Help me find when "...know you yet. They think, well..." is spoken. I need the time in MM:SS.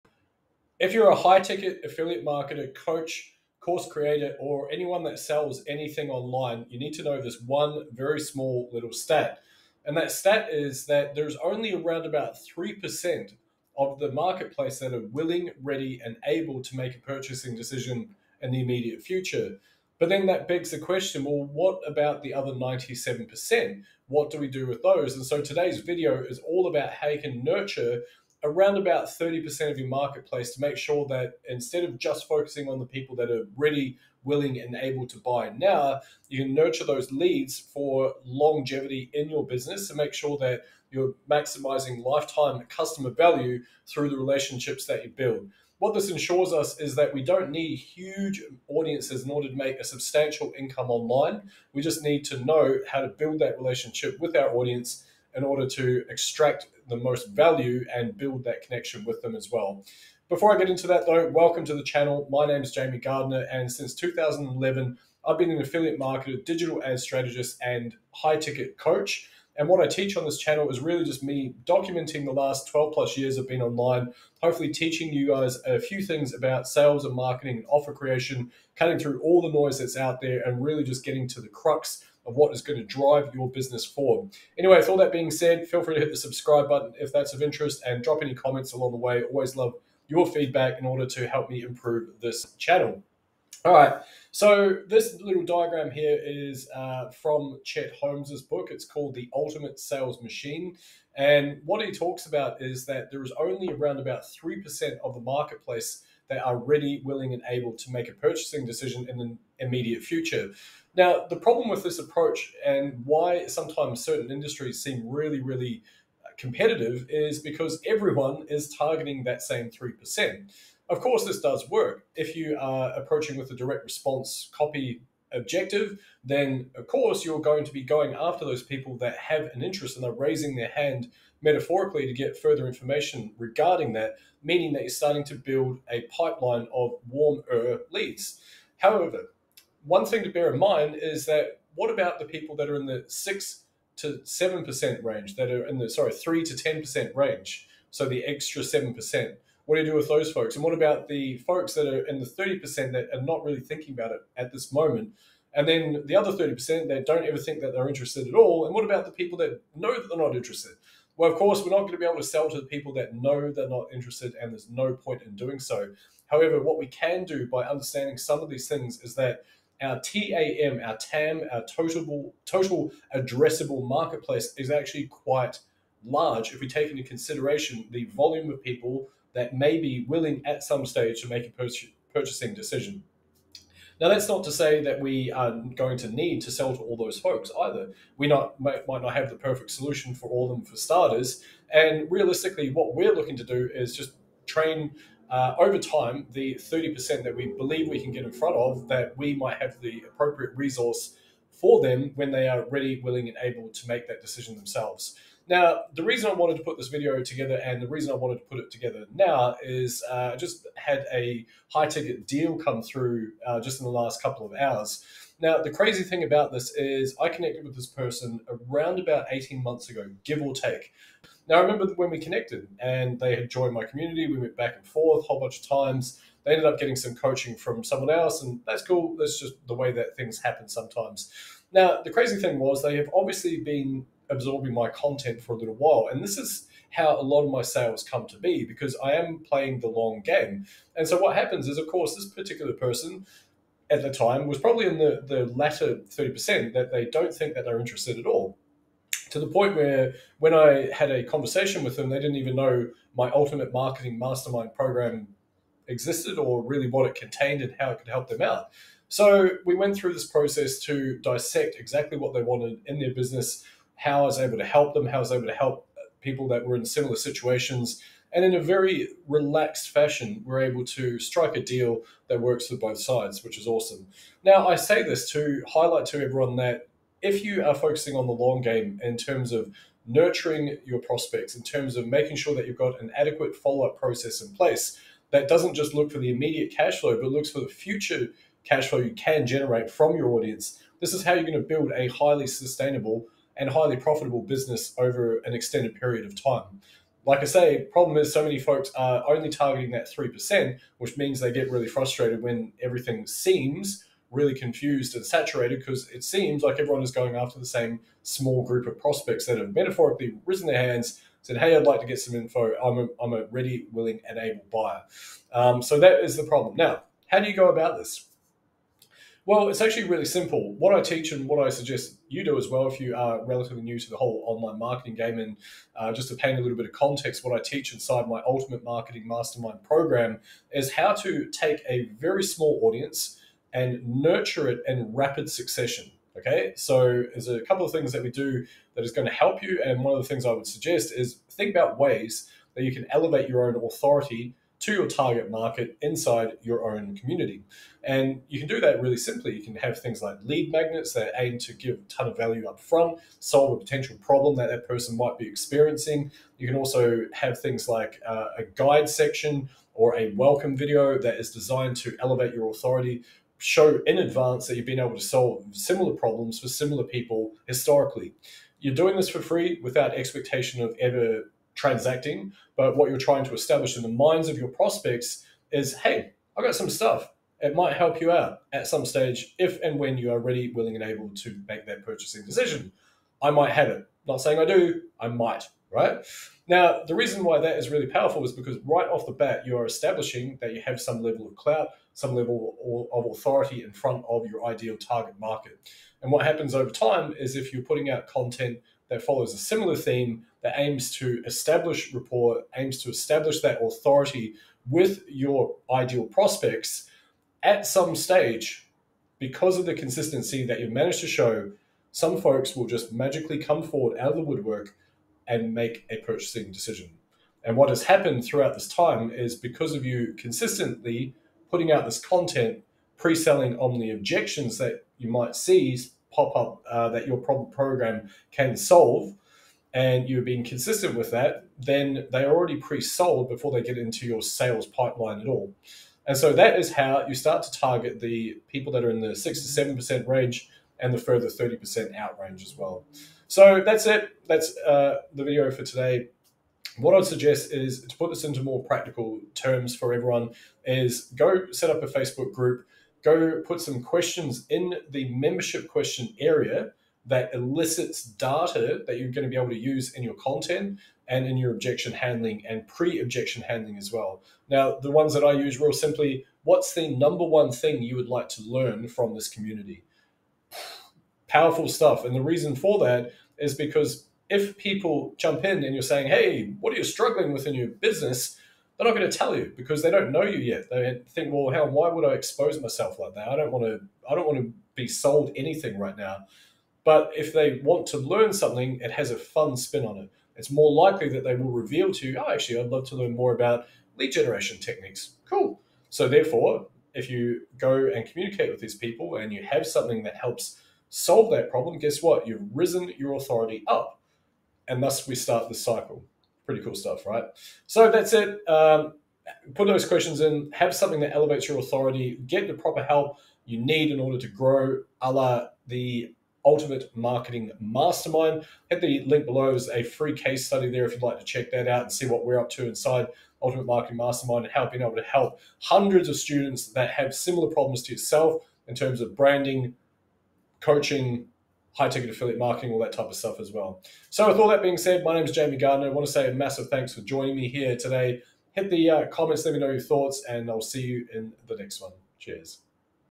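08:00.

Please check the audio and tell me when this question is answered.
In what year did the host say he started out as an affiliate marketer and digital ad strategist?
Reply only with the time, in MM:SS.
01:03.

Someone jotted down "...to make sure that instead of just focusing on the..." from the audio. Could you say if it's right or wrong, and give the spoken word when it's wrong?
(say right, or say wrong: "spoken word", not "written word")
right.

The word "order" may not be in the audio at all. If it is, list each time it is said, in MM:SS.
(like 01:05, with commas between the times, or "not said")
00:49, 00:55, 01:30, 08:34.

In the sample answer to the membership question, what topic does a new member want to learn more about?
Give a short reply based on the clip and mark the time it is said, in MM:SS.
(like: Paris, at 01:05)
lead generation techniques, at 08:14.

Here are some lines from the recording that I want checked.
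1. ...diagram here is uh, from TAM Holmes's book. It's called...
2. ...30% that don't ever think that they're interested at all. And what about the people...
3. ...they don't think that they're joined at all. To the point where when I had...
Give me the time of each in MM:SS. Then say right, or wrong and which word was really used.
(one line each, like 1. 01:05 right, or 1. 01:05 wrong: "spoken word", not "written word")
1. 01:35 wrong: "Chet", not "TAM"
2. 02:36 right
3. 04:06 wrong: "interested", not "joined".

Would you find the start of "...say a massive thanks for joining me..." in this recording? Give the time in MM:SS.
08:56.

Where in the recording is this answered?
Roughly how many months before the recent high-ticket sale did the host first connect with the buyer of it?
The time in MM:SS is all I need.
03:39.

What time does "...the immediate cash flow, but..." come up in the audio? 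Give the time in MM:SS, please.
04:46.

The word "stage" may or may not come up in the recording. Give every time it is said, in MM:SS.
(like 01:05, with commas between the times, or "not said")
03:00, 06:19, 06:48.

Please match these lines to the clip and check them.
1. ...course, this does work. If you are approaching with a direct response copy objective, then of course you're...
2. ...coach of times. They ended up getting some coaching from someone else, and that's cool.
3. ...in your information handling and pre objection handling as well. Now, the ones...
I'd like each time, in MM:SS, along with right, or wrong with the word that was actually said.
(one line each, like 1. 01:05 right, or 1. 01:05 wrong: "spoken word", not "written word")
1. 02:01 right
2. 03:45 wrong: "bunch", not "coach"
3. 07:41 wrong: "objection", not "information".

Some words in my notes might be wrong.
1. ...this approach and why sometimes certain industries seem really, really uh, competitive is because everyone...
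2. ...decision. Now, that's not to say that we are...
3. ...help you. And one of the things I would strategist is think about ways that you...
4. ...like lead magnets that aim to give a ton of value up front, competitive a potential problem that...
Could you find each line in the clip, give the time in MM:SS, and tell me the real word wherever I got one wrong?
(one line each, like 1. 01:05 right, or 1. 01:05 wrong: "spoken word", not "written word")
1. 01:51 right
2. 03:02 right
3. 05:39 wrong: "suggest", not "strategist"
4. 05:50 wrong: "solve", not "competitive".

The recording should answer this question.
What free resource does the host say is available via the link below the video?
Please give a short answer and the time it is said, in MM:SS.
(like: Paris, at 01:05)
case study, at 08:40.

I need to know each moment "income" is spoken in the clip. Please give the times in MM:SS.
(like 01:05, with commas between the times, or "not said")
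00:50.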